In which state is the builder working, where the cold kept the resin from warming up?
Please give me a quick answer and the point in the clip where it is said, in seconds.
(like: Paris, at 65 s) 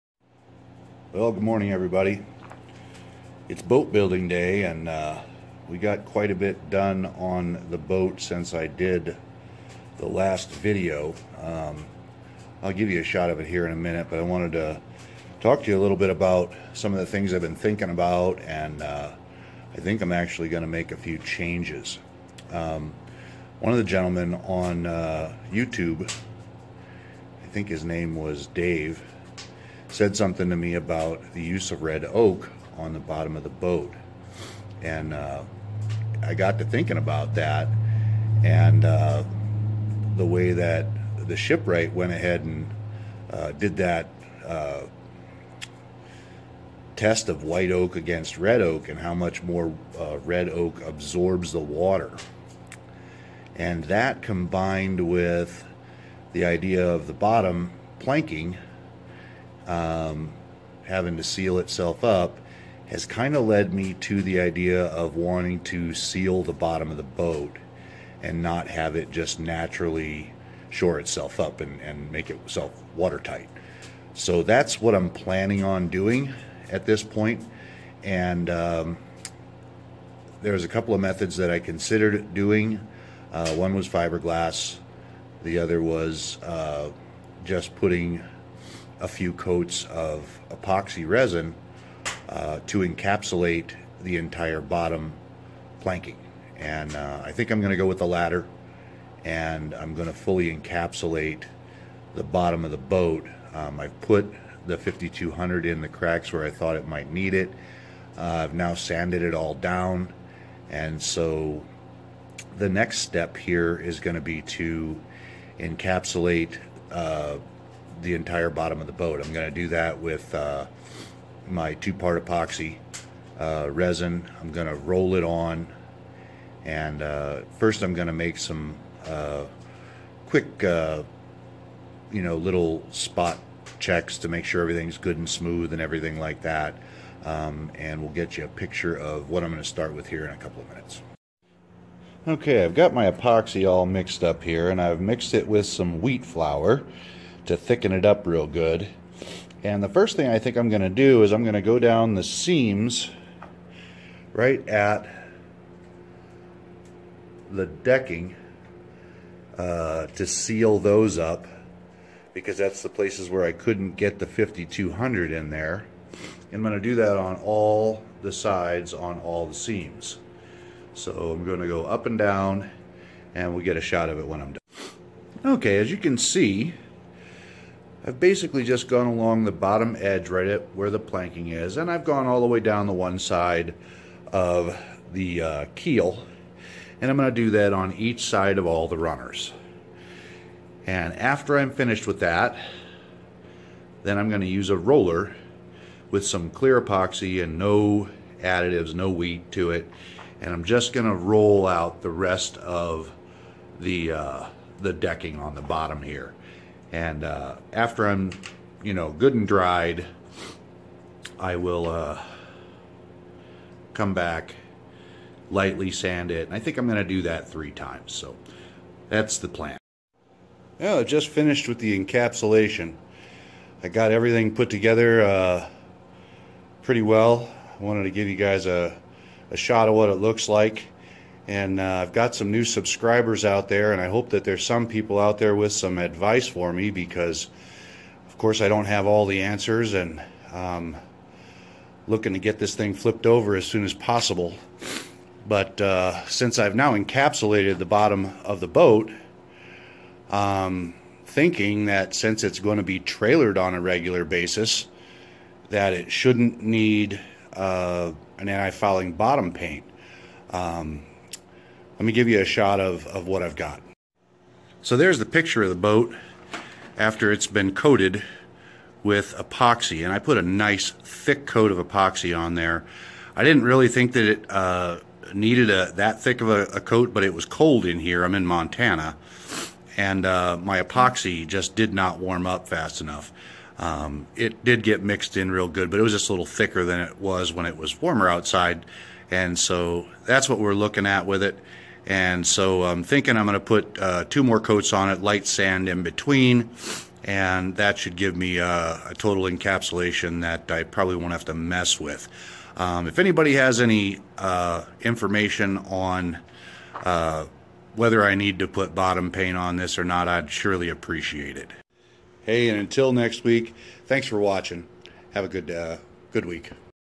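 Montana, at 278 s.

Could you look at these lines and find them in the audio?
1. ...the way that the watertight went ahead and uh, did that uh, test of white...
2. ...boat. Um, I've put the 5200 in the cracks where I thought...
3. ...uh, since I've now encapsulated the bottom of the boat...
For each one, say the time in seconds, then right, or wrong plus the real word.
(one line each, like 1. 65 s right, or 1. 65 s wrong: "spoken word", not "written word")
1. 40 s wrong: "shipwright", not "watertight"
2. 102 s right
3. 245 s right.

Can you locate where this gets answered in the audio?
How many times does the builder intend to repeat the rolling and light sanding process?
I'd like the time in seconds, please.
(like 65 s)
217 s.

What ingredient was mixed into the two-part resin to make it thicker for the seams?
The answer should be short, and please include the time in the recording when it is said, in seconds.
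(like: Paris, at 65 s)
wheat flour, at 146 s.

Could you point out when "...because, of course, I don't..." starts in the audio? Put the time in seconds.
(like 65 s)
236 s.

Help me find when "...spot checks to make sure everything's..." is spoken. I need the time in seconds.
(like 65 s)
132 s.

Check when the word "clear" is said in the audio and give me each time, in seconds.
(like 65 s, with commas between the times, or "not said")
196 s.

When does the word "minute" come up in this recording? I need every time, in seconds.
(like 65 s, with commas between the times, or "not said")
13 s, 140 s.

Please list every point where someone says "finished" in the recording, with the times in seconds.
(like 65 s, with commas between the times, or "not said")
191 s, 221 s.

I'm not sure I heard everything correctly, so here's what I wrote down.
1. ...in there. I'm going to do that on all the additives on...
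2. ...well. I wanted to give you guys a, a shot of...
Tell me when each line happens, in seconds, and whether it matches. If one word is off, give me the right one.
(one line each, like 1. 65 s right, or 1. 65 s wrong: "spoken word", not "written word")
1. 165 s wrong: "sides", not "additives"
2. 227 s right.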